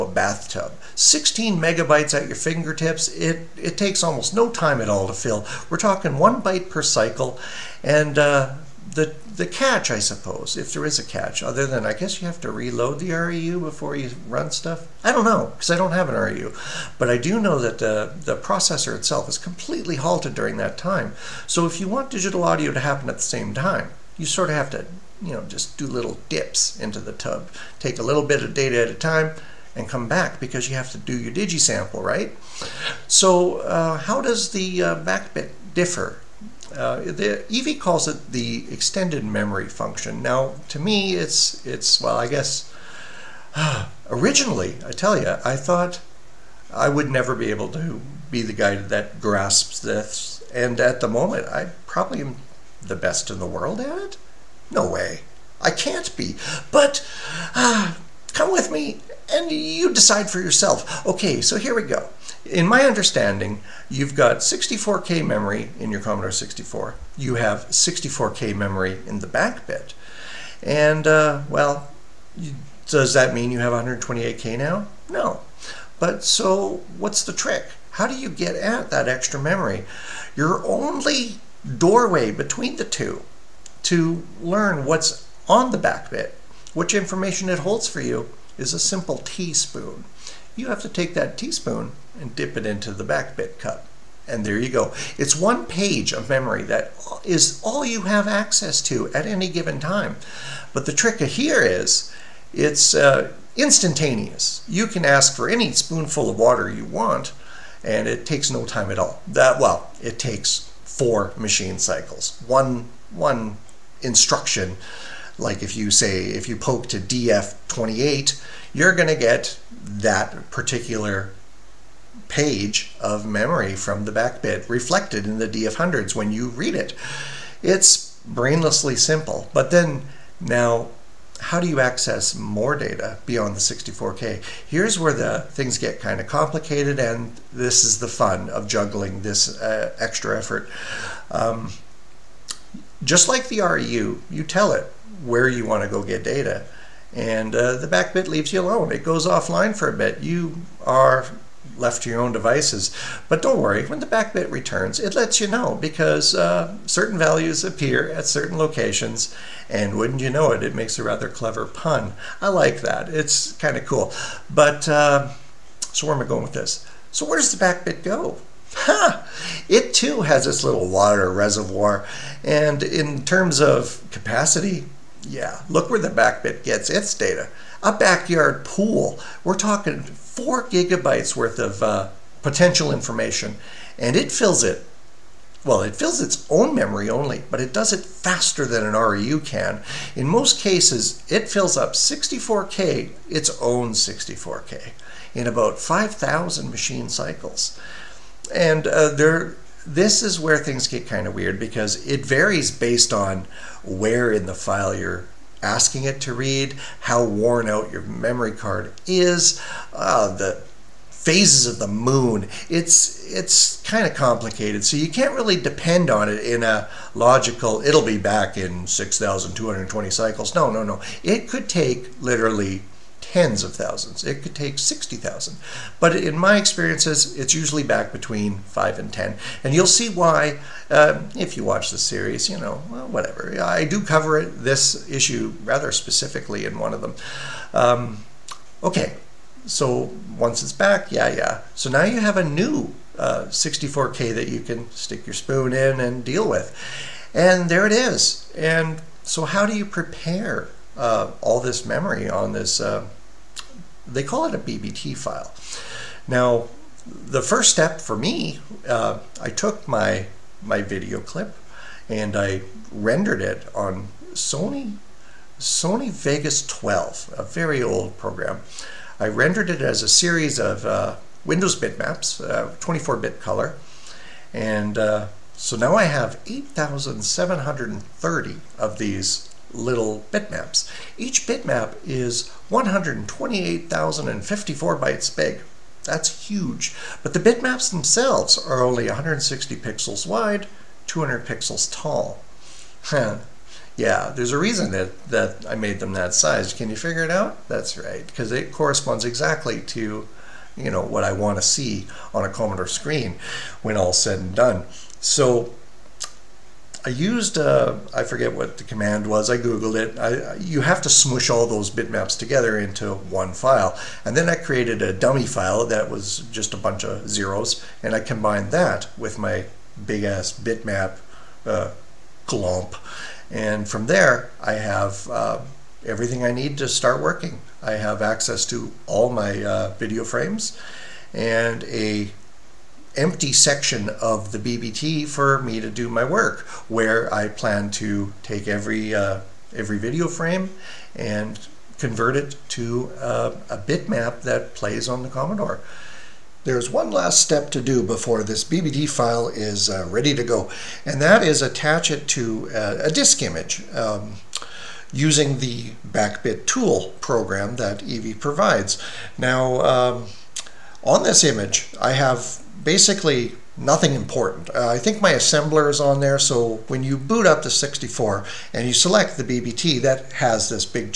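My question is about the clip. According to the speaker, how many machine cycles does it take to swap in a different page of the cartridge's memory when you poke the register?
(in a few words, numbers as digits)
4.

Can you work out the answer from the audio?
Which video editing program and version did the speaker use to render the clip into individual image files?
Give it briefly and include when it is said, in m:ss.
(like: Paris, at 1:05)
Sony Vegas 12, at 4:25.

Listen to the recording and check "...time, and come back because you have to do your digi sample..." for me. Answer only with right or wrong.
right.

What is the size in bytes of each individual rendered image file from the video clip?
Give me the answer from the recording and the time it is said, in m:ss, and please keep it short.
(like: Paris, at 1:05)
128,054 bytes, at 4:42.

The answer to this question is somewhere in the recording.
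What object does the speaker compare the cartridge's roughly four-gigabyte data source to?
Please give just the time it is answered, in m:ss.
2:57.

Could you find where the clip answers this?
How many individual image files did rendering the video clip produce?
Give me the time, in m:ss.
4:36.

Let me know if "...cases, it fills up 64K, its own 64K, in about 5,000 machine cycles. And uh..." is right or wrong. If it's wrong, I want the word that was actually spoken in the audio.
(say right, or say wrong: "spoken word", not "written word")
right.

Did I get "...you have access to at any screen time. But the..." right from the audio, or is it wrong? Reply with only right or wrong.
wrong.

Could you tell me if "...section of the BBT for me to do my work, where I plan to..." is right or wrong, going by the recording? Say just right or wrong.
right.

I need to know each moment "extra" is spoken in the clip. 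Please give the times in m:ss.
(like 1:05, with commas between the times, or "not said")
1:19, 2:19.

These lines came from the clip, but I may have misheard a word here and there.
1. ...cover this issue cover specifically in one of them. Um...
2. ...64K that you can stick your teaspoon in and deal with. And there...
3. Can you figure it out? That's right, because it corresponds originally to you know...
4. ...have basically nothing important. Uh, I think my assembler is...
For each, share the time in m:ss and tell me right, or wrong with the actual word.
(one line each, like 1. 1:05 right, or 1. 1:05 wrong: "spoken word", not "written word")
1. 3:53 wrong: "rather", not "cover"
2. 4:03 wrong: "spoon", not "teaspoon"
3. 4:56 wrong: "exactly", not "originally"
4. 6:02 right.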